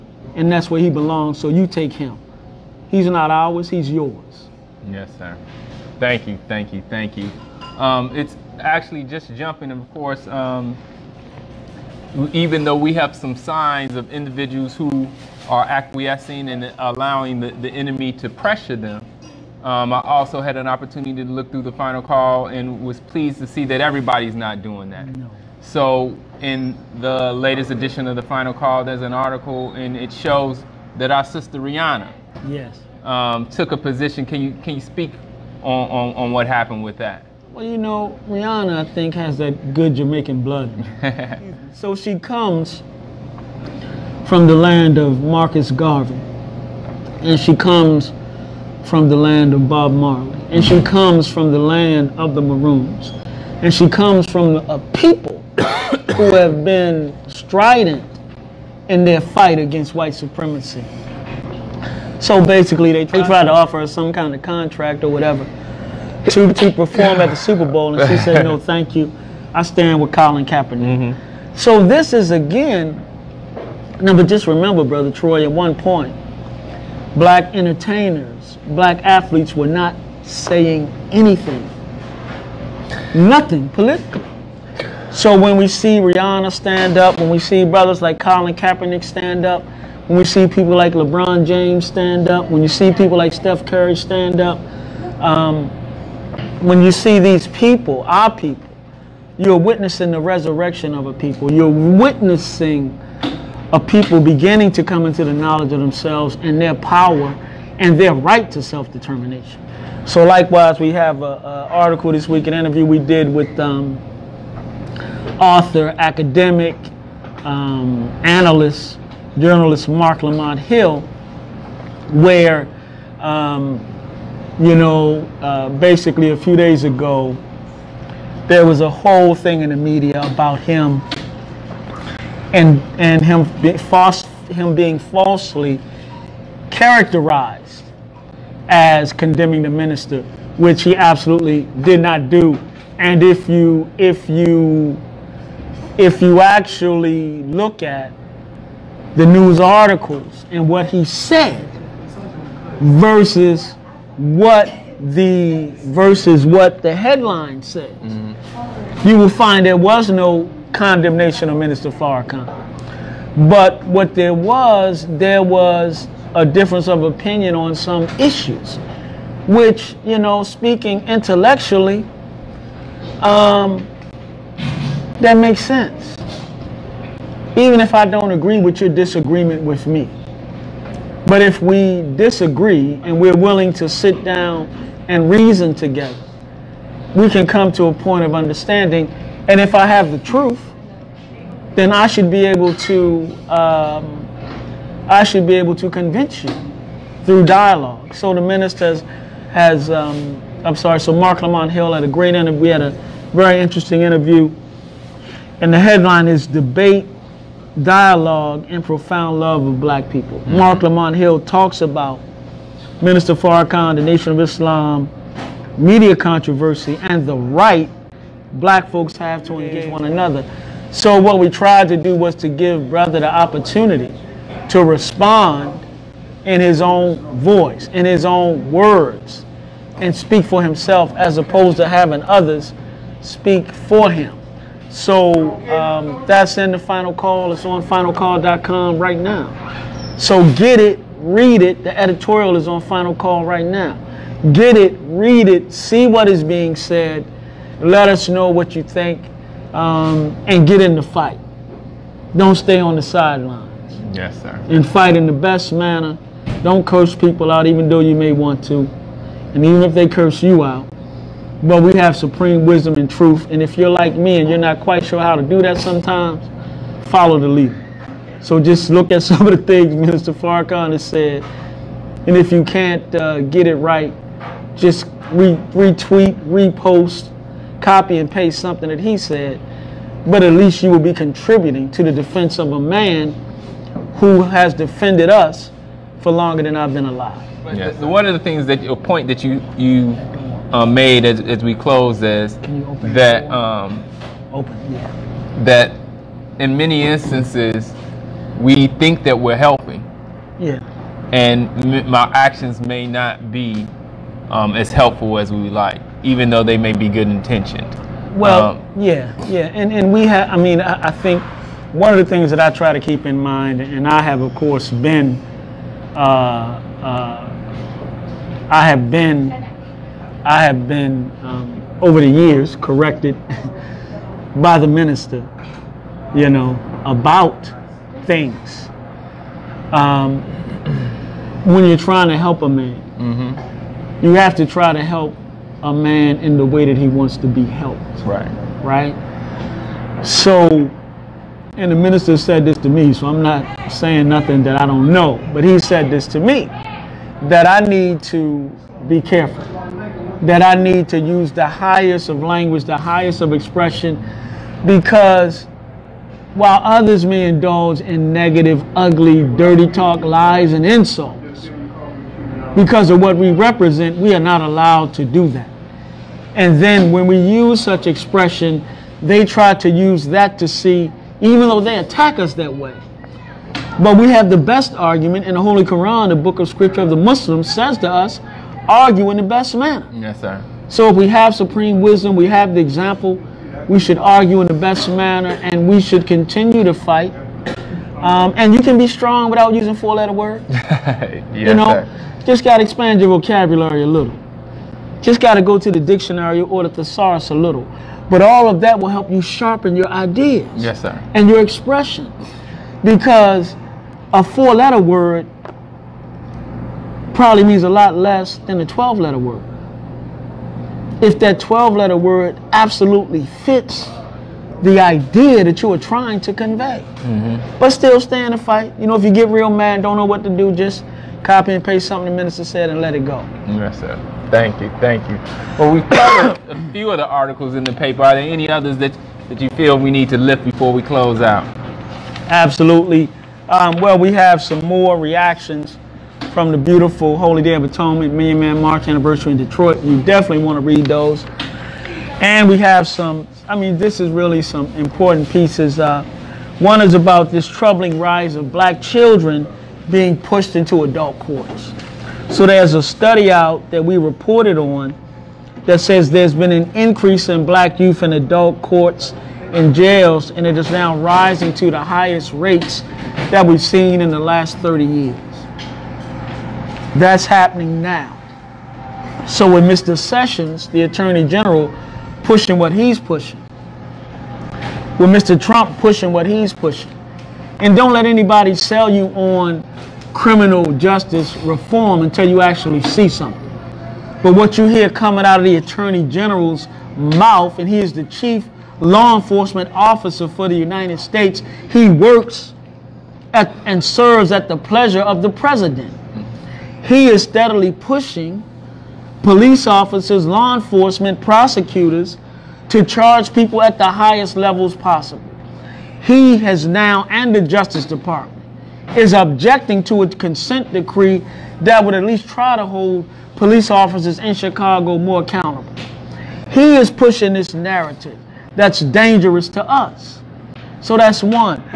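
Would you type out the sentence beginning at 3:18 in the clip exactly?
So the minister has, has um, I'm sorry, so Marc Lamont Hill had a great interview.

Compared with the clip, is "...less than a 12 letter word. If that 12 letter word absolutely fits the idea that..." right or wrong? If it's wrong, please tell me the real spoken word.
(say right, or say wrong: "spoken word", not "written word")
right.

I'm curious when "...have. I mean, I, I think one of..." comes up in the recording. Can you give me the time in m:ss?
5:10.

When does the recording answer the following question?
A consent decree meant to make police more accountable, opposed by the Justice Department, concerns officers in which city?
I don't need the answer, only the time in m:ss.
8:34.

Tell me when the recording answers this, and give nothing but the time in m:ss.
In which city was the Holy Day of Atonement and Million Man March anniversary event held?
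7:19.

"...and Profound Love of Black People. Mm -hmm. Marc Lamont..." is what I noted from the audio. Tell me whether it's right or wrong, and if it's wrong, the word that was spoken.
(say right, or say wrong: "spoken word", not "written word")
right.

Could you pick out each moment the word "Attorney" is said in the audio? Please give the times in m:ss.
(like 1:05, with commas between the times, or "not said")
7:51, 8:05.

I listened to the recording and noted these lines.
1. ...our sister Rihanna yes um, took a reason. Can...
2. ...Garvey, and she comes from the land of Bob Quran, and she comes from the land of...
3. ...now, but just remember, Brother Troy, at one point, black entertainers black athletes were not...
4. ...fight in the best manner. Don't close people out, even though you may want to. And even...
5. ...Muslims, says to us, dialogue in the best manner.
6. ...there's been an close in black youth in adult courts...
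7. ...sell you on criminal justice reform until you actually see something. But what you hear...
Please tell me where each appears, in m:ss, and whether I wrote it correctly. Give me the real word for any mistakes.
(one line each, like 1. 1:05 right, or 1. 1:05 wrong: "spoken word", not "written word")
1. 0:31 wrong: "position", not "reason"
2. 0:45 wrong: "Marley", not "Quran"
3. 1:14 right
4. 4:14 wrong: "curse", not "close"
5. 6:17 wrong: "argue", not "dialogue"
6. 7:36 wrong: "increase", not "close"
7. 7:58 right.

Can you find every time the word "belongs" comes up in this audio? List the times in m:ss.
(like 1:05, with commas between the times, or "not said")
0:00.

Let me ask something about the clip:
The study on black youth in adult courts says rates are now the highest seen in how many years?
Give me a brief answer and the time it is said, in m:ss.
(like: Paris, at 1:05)
30, at 7:44.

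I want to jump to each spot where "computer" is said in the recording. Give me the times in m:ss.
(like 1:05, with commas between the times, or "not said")
not said.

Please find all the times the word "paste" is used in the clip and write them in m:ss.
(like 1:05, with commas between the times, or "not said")
4:38, 7:01.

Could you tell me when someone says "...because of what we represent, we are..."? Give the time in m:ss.
6:02.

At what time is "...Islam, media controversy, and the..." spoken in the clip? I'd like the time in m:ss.
3:34.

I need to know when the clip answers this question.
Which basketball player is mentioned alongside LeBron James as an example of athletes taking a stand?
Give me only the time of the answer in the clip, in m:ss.
1:33.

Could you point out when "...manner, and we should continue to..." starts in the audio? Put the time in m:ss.
6:25.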